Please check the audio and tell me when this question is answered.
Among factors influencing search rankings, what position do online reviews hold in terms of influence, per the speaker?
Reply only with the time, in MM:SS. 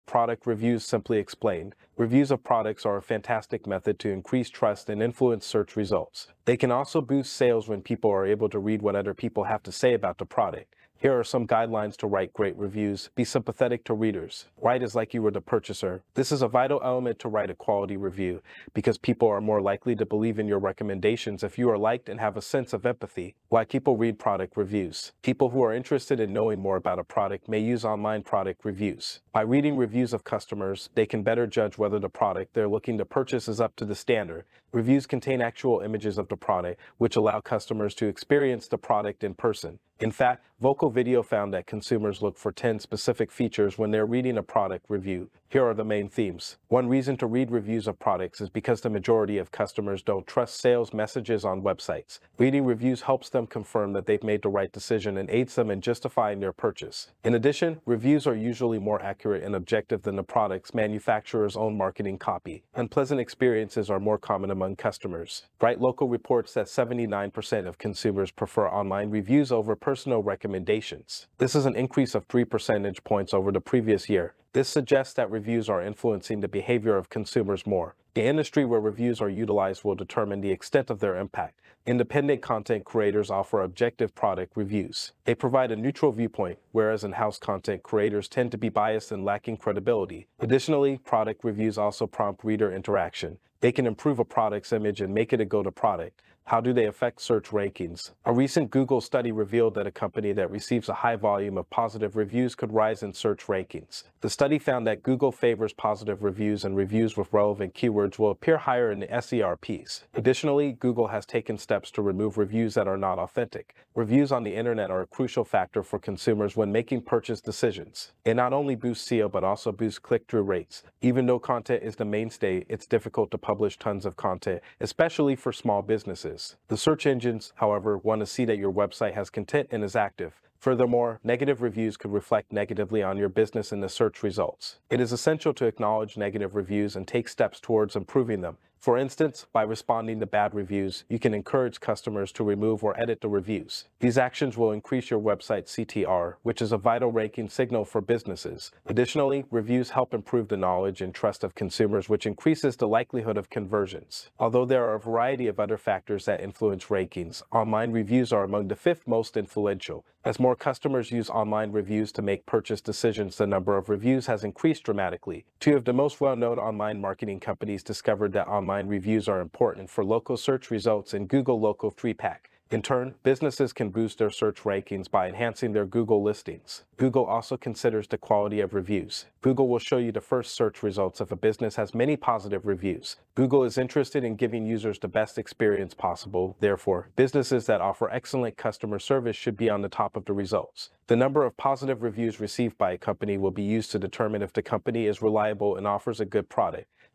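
02:38.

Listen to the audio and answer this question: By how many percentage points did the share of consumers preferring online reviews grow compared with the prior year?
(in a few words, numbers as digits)
3.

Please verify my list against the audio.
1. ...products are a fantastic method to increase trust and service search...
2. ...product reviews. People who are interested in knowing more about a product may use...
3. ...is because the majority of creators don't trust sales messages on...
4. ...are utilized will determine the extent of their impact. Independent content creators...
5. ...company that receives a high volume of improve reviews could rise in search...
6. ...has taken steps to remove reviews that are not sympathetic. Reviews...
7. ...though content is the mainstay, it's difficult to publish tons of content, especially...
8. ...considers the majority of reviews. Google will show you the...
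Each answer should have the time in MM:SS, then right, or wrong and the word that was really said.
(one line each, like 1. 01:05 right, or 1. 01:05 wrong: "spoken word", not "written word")
1. 00:02 wrong: "influence", not "service"
2. 00:24 right
3. 00:48 wrong: "customers", not "creators"
4. 01:19 right
5. 01:40 wrong: "positive", not "improve"
6. 01:51 wrong: "authentic", not "sympathetic"
7. 02:01 right
8. 02:57 wrong: "quality", not "majority".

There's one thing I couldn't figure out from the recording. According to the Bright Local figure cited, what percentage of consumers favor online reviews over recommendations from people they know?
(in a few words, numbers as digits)
79%.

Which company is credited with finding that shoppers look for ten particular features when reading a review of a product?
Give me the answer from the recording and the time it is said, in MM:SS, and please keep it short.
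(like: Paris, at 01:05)
Vocal Video, at 00:40.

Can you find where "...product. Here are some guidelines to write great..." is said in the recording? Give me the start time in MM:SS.
00:10.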